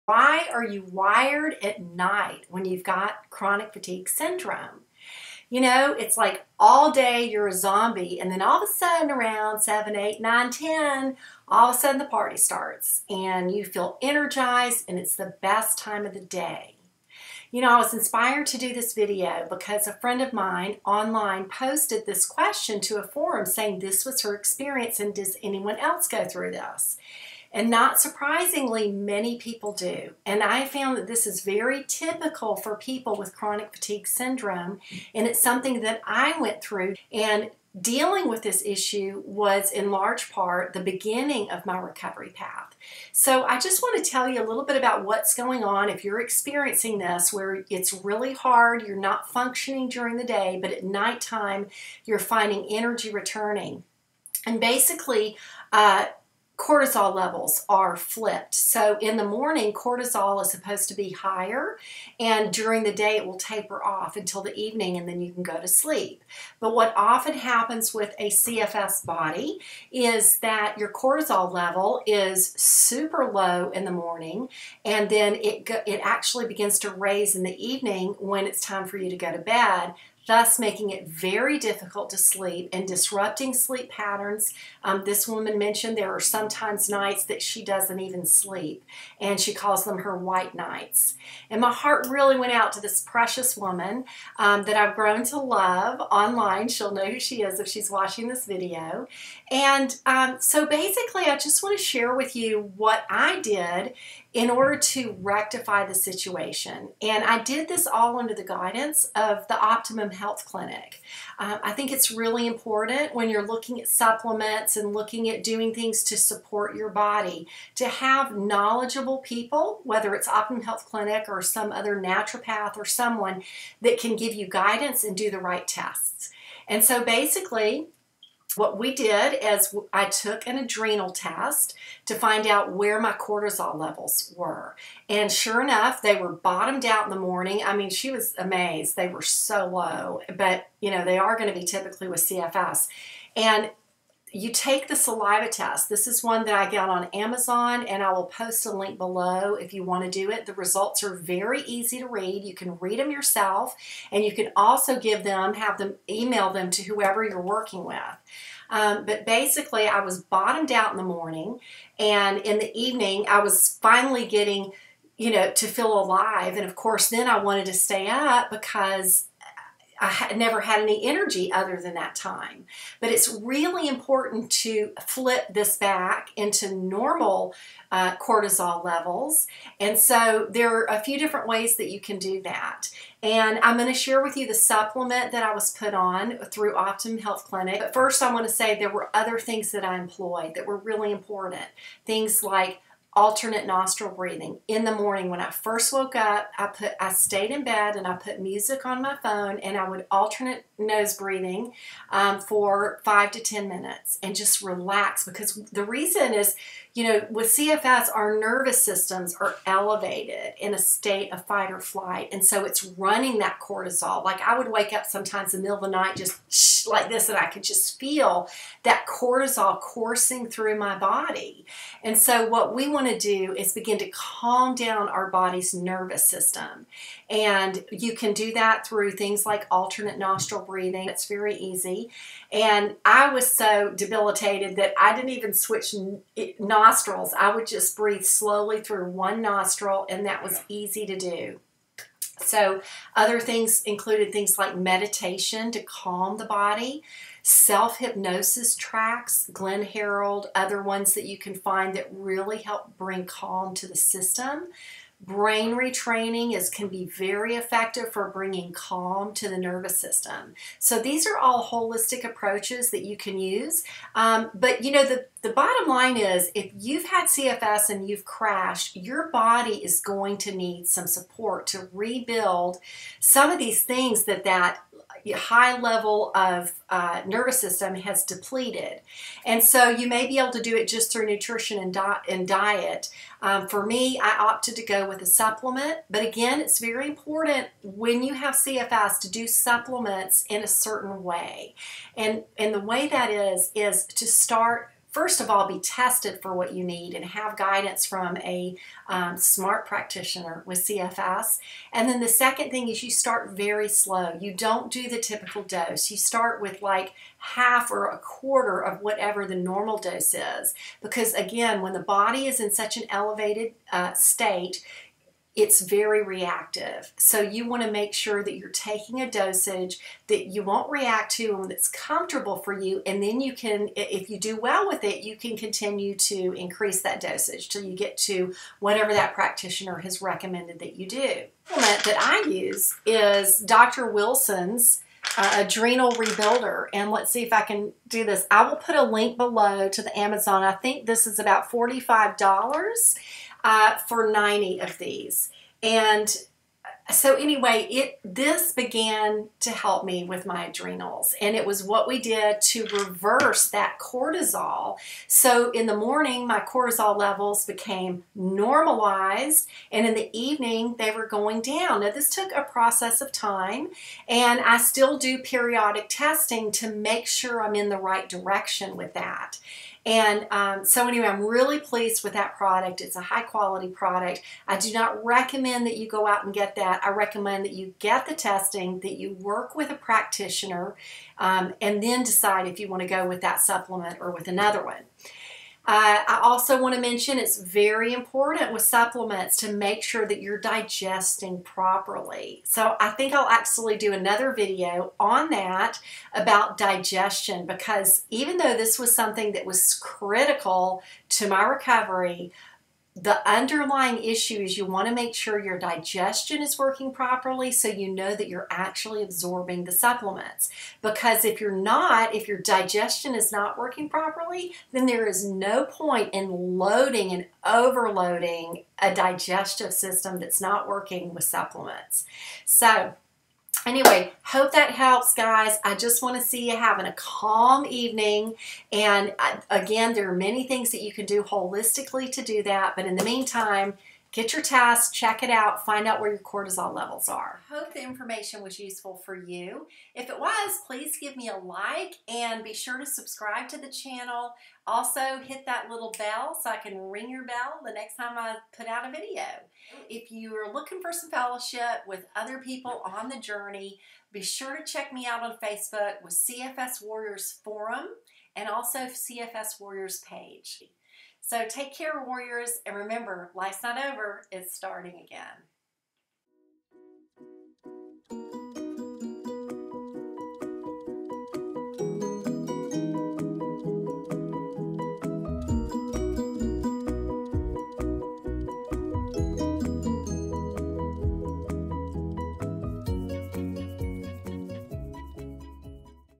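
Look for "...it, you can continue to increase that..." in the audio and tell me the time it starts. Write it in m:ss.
5:25.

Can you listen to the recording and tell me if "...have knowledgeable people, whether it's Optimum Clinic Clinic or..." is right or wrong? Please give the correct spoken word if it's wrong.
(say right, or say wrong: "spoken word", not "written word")
wrong: "Health", not "Clinic".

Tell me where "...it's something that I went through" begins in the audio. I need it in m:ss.
0:35.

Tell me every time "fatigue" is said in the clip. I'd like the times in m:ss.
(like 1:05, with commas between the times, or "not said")
0:03, 0:33.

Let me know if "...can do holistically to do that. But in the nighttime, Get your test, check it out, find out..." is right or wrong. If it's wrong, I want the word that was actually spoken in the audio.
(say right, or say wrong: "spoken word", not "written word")
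wrong: "meantime", not "nighttime".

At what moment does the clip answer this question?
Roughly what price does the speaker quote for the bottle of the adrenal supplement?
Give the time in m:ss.
5:41.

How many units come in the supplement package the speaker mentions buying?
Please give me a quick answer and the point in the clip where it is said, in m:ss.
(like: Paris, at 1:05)
90, at 5:44.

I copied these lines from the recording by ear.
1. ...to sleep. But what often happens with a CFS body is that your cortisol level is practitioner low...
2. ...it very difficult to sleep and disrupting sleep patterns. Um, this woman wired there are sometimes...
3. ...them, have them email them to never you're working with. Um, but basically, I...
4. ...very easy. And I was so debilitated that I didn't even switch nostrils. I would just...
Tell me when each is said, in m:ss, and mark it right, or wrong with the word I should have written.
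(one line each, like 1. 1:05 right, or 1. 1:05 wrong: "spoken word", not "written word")
1. 1:05 wrong: "super", not "practitioner"
2. 1:20 wrong: "mentioned", not "wired"
3. 2:35 wrong: "whoever", not "never"
4. 3:51 right.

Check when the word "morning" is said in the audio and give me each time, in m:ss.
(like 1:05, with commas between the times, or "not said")
0:59, 1:13, 2:17, 2:41, 3:14, 5:55.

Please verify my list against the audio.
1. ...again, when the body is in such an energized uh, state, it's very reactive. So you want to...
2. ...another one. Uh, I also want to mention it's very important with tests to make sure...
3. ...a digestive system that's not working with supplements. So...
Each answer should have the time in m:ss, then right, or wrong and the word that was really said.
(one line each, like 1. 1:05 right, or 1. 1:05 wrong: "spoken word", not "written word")
1. 5:11 wrong: "elevated", not "energized"
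2. 6:24 wrong: "supplements", not "tests"
3. 6:59 right.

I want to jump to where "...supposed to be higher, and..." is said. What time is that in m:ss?
1:00.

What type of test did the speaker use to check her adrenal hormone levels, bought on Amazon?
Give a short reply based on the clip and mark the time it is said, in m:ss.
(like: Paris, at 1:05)
saliva test, at 2:24.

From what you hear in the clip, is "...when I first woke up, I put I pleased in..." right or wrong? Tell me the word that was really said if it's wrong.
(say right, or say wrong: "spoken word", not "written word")
wrong: "stayed", not "pleased".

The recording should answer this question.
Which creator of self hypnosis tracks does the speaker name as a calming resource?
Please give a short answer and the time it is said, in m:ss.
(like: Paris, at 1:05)
Glenn Harrold, at 4:09.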